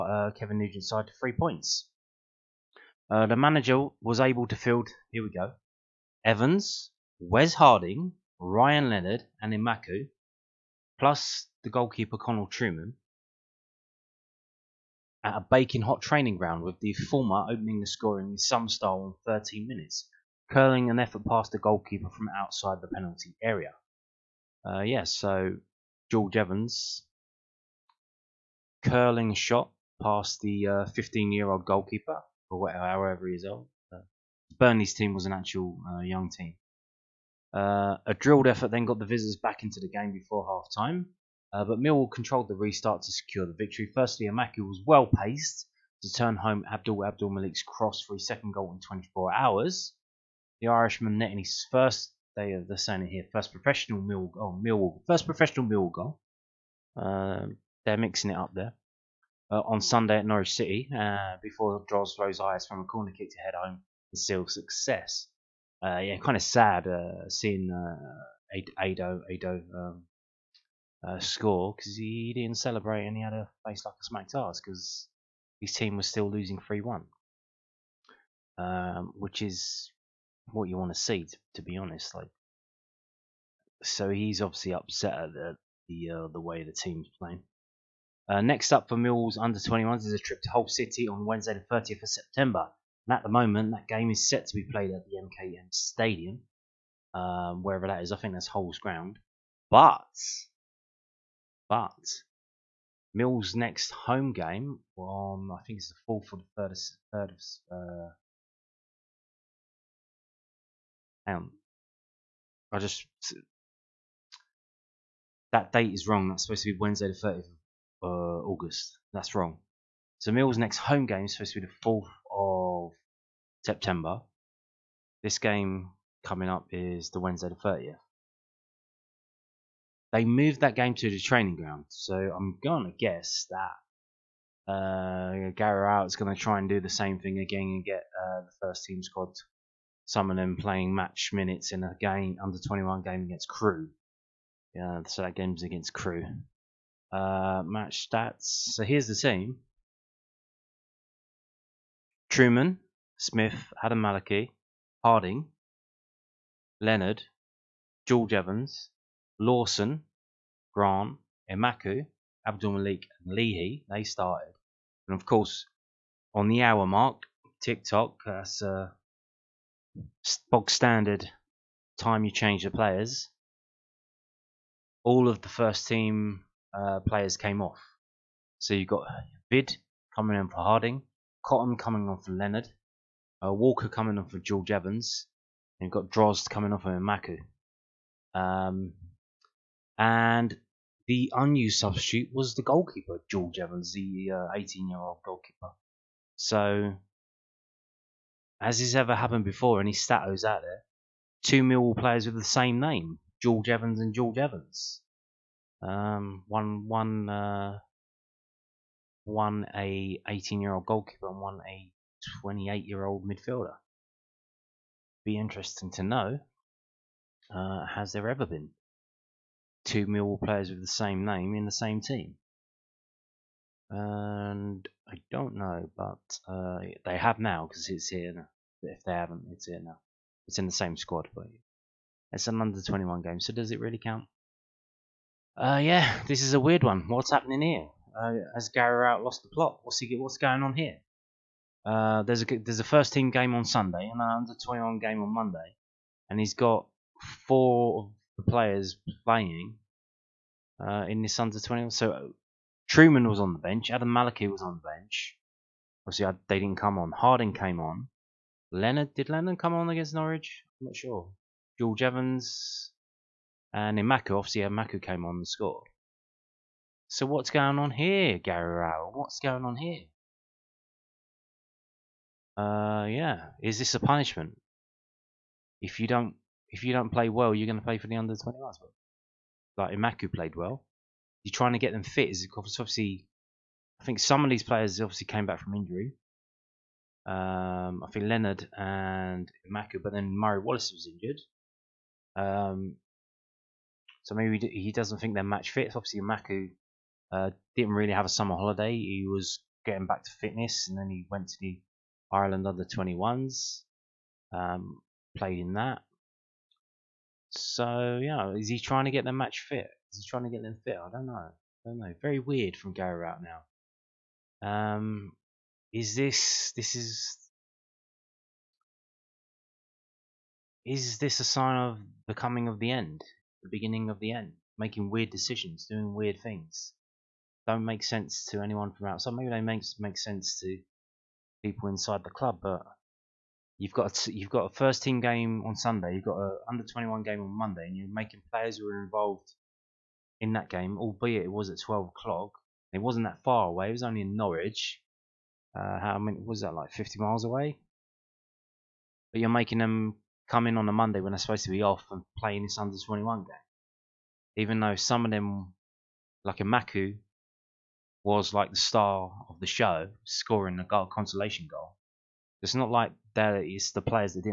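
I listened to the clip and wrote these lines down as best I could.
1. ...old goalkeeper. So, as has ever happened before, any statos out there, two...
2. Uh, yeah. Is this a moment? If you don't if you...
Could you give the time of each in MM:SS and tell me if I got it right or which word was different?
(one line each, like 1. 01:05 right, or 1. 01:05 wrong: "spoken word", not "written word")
1. 03:14 right
2. 04:32 wrong: "punishment", not "moment".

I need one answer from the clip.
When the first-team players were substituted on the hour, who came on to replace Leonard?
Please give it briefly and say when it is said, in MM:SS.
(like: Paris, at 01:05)
Cotton, at 03:01.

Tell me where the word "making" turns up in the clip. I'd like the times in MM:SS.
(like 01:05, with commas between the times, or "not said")
05:24, 05:38, 05:49.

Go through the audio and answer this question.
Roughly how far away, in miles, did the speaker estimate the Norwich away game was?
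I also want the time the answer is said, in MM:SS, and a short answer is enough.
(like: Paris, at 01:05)
50, at 05:46.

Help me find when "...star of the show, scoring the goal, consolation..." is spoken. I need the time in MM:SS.
05:58.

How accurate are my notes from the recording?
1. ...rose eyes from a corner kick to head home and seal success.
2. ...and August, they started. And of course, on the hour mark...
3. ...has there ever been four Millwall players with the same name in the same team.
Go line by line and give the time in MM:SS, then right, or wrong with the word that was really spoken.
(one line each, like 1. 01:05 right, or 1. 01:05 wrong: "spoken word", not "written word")
1. 01:02 right
2. 02:43 wrong: "Leahy", not "August"
3. 03:37 wrong: "two", not "four".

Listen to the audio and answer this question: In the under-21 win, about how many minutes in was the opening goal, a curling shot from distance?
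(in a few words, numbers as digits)
13.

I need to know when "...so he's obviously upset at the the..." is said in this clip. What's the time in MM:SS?
01:23.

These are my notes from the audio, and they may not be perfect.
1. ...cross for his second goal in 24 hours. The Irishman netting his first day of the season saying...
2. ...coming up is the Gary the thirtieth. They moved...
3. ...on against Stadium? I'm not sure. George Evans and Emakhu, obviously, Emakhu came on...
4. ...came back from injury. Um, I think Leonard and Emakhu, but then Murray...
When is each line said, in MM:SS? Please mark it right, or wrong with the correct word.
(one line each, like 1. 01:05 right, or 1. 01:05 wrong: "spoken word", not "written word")
1. 00:47 right
2. 02:06 wrong: "Wednesday", not "Gary"
3. 04:19 wrong: "Norwich", not "Stadium"
4. 04:45 right.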